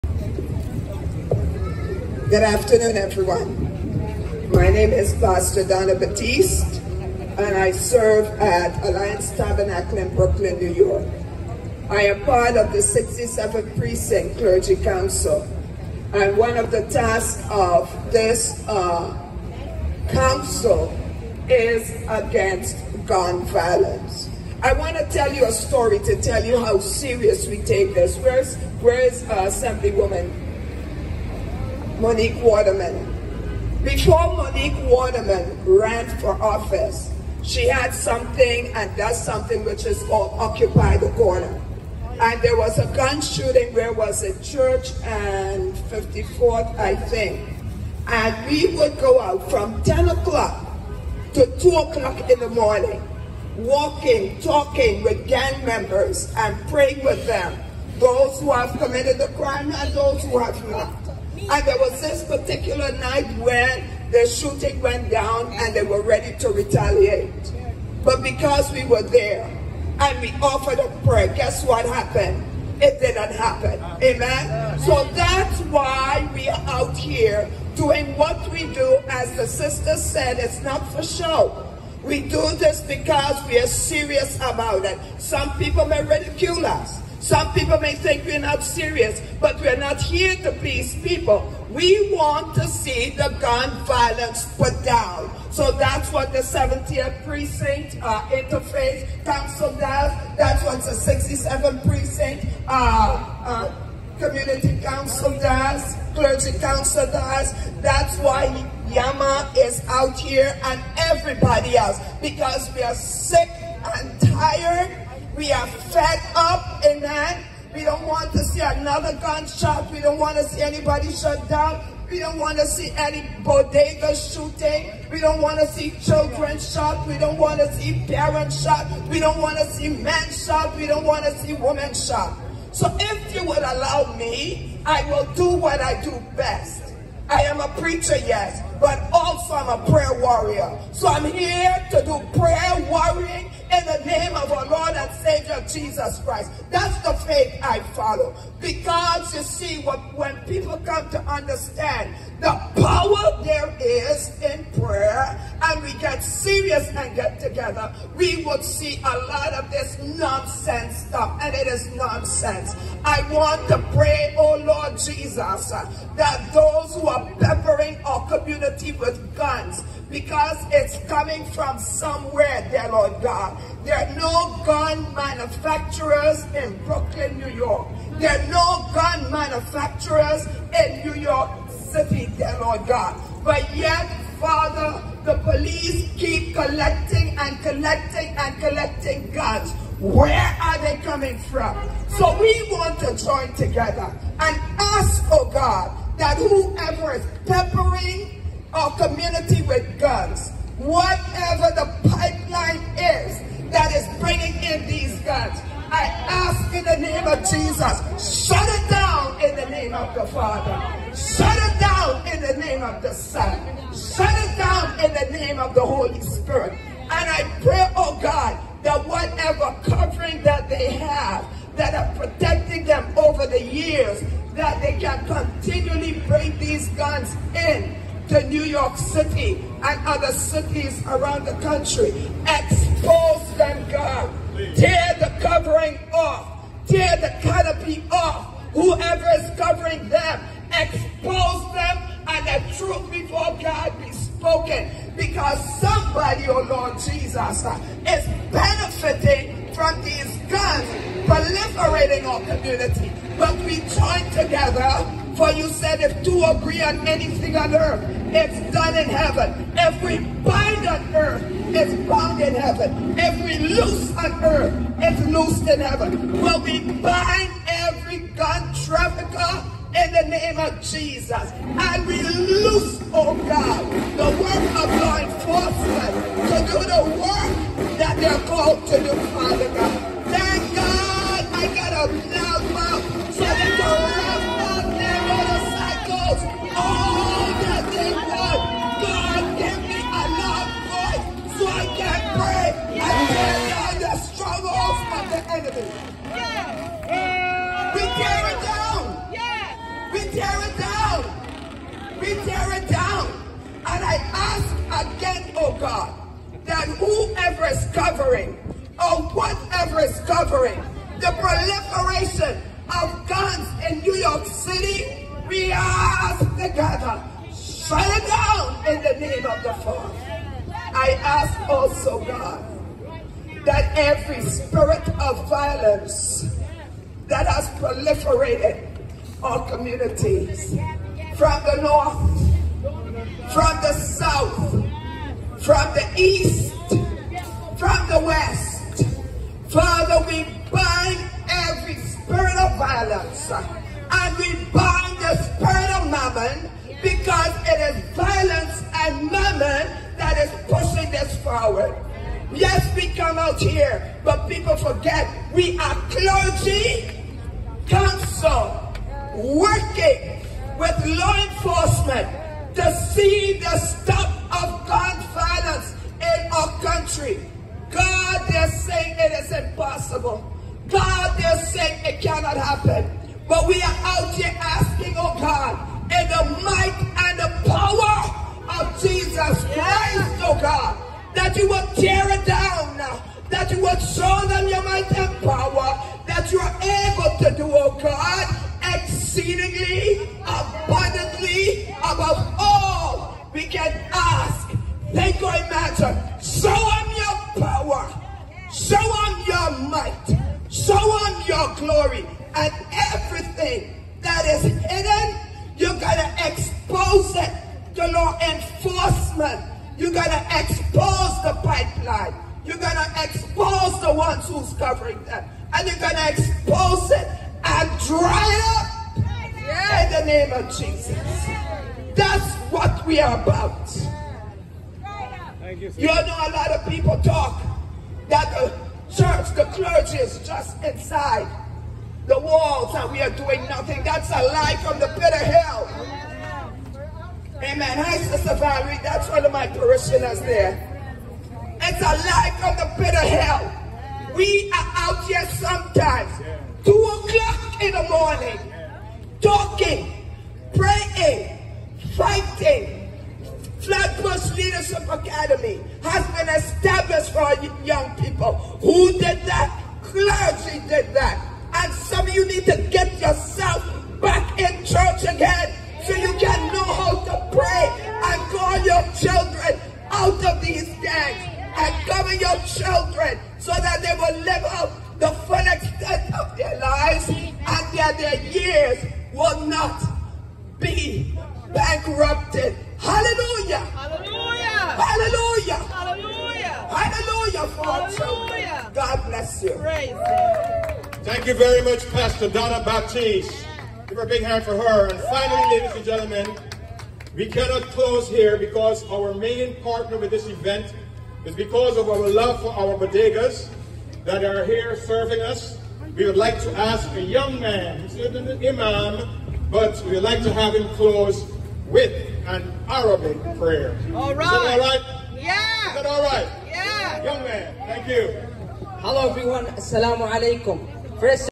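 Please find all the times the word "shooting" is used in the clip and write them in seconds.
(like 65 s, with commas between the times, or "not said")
43 s, 64 s, 124 s.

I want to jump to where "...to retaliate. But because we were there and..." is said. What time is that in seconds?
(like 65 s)
66 s.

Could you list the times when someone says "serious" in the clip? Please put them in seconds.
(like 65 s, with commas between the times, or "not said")
26 s, 83 s, 88 s, 156 s.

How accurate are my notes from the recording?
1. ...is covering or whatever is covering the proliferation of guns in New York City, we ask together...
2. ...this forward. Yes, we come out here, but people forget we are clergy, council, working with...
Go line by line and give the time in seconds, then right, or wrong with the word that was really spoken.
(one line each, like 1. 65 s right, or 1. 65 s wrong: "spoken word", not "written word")
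1. 307 s right
2. 351 s right.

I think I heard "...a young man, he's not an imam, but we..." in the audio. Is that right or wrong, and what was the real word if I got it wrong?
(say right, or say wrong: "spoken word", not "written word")
right.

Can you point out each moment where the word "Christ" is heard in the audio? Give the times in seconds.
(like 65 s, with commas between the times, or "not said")
146 s, 379 s.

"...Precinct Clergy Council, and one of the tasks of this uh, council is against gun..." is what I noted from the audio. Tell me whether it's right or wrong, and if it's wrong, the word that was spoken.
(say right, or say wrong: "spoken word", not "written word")
right.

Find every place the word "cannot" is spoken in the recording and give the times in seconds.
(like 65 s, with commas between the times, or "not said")
372 s, 497 s.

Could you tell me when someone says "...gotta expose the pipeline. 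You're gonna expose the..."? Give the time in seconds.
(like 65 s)
410 s.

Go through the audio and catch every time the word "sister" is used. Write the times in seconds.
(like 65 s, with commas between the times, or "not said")
79 s, 438 s.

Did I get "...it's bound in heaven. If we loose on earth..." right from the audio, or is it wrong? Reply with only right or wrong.
right.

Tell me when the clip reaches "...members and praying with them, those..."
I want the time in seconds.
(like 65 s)
55 s.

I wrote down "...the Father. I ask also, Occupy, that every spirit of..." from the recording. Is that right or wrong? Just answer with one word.
wrong.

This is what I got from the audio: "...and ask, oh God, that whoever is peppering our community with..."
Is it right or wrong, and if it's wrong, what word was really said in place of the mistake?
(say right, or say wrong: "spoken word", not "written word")
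right.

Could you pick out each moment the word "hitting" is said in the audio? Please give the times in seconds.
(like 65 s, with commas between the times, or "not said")
not said.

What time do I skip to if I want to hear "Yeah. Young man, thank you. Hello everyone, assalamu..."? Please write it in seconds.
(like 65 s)
516 s.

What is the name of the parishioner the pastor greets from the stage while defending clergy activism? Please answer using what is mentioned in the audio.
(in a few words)
Valerie.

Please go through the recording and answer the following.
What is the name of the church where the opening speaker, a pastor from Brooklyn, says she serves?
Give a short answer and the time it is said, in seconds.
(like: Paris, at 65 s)
Alliance Tabernacle, at 8 s.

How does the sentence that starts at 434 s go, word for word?
That's a lie from the pit of hell.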